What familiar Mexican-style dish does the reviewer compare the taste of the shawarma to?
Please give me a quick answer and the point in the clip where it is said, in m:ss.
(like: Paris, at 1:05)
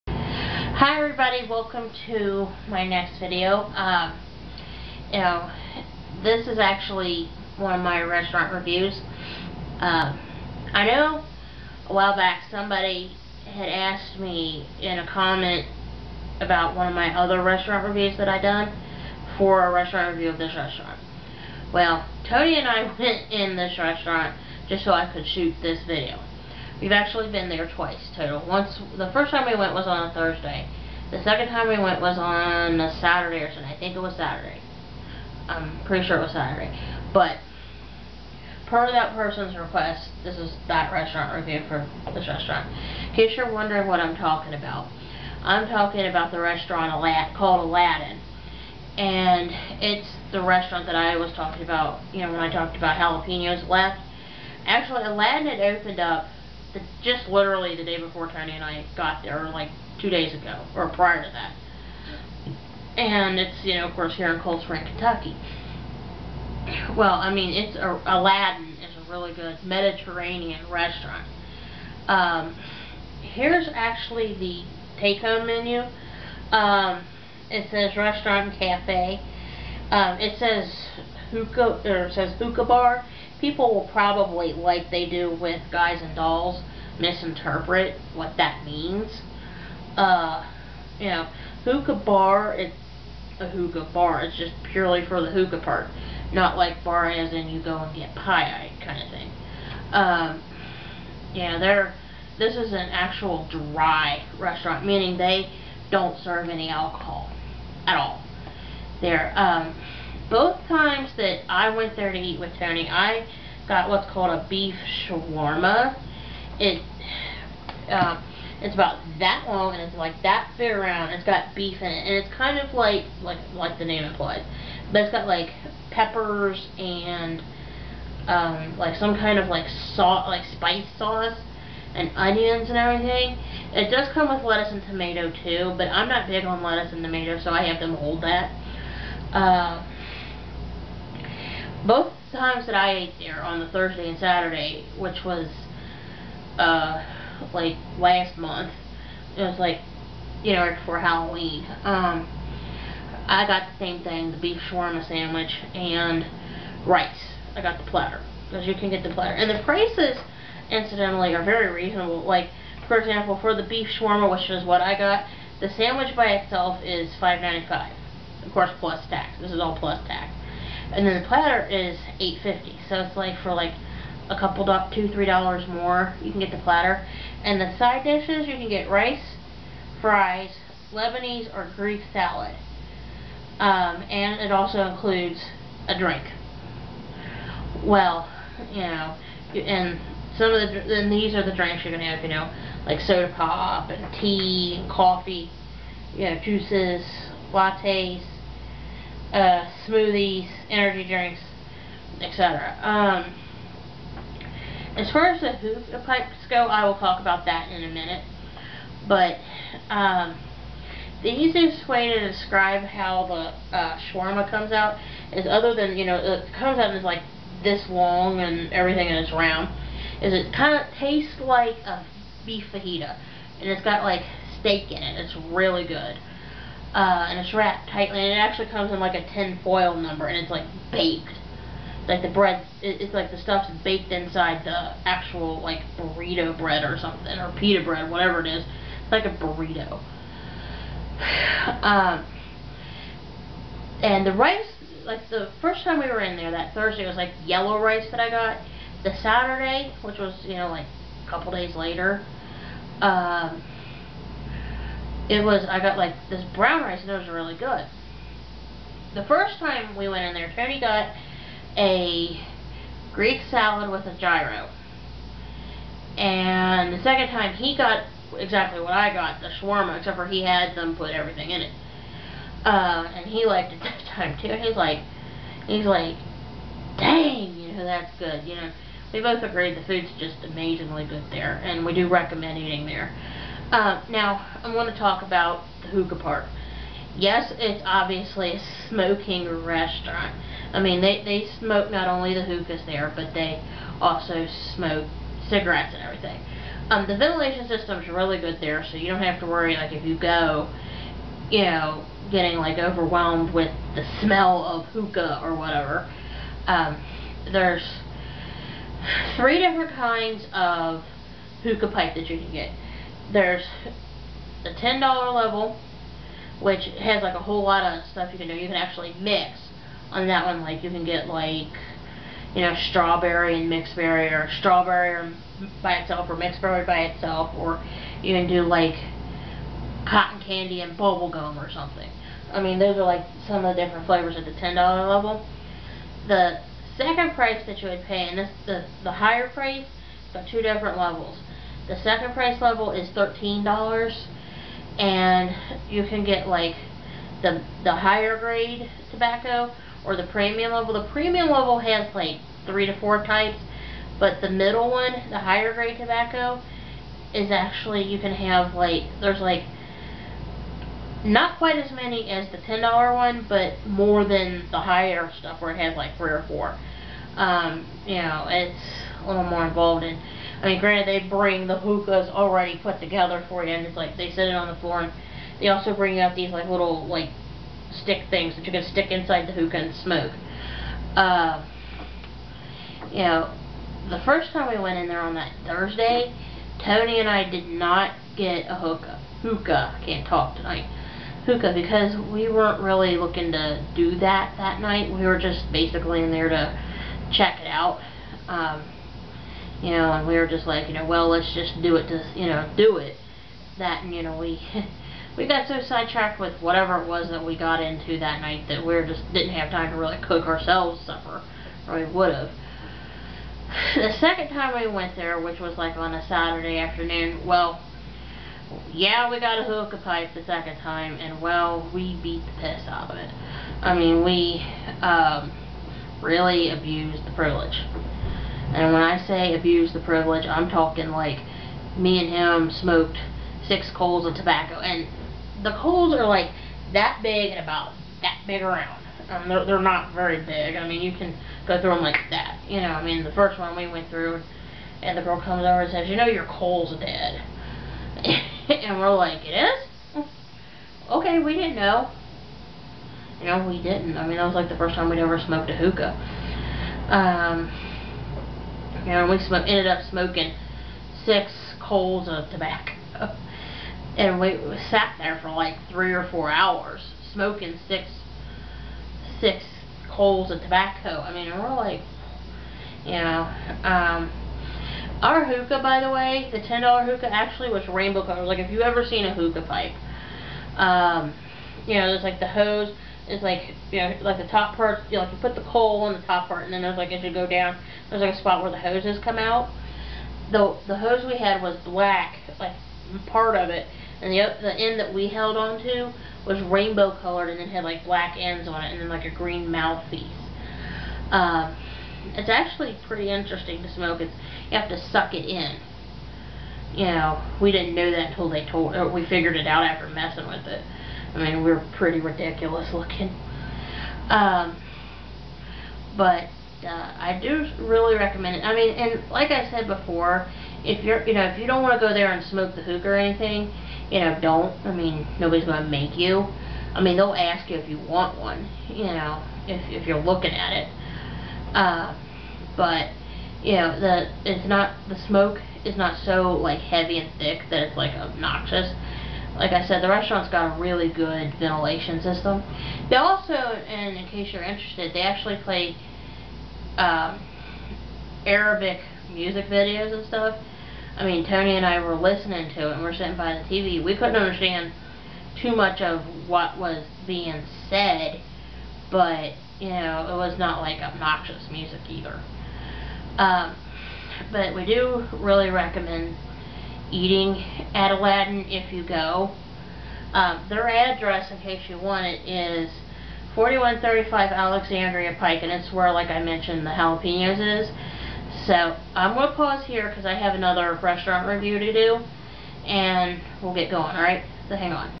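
Beef fajita, at 3:42.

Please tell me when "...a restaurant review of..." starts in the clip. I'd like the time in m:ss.
0:19.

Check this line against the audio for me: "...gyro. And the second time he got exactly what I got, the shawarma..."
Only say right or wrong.
right.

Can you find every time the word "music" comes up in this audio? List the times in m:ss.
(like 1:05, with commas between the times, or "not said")
9:09, 9:21.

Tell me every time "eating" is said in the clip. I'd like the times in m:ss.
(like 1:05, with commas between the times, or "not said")
4:42, 9:27.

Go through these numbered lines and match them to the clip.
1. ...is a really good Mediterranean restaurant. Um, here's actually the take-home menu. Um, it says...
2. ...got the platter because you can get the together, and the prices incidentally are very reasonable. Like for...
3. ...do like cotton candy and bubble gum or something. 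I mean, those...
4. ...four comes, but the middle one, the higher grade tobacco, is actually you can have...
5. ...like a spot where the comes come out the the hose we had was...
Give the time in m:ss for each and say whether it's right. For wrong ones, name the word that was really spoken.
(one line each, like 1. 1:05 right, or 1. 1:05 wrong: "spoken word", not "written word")
1. 1:08 right
2. 2:37 wrong: "platter", not "together"
3. 5:28 right
4. 5:52 wrong: "types", not "comes"
5. 8:08 wrong: "hoses", not "comes".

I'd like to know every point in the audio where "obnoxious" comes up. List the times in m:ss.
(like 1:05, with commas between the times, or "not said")
8:58, 9:21.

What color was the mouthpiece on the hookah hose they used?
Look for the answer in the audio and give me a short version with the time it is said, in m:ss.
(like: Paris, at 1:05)
Green, at 8:19.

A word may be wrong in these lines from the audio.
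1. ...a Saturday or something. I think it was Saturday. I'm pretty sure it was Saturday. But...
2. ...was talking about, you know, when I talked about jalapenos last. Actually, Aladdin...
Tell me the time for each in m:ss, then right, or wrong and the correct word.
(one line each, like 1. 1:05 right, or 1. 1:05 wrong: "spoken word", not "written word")
1. 0:32 right
2. 0:51 right.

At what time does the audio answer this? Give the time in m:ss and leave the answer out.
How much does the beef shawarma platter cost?
2:52.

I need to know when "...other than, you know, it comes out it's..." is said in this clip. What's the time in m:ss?
3:35.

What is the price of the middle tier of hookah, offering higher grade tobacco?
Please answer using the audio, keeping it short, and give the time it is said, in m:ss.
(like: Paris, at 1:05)
$13, at 5:43.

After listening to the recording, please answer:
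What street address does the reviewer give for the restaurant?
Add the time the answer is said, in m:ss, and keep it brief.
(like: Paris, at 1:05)
4135 Alexandria Pike, at 9:33.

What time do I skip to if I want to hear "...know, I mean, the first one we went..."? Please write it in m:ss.
7:22.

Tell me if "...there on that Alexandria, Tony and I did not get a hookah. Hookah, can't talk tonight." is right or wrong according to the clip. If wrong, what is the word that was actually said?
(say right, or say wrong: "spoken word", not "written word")
wrong: "Thursday", not "Alexandria".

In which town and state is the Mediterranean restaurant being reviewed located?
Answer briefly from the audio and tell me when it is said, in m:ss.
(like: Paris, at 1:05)
Cold Spring, Kentucky, at 1:04.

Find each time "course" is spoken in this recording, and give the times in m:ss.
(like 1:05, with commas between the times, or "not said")
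1:03, 2:48.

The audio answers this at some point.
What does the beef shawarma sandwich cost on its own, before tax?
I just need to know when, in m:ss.
2:47.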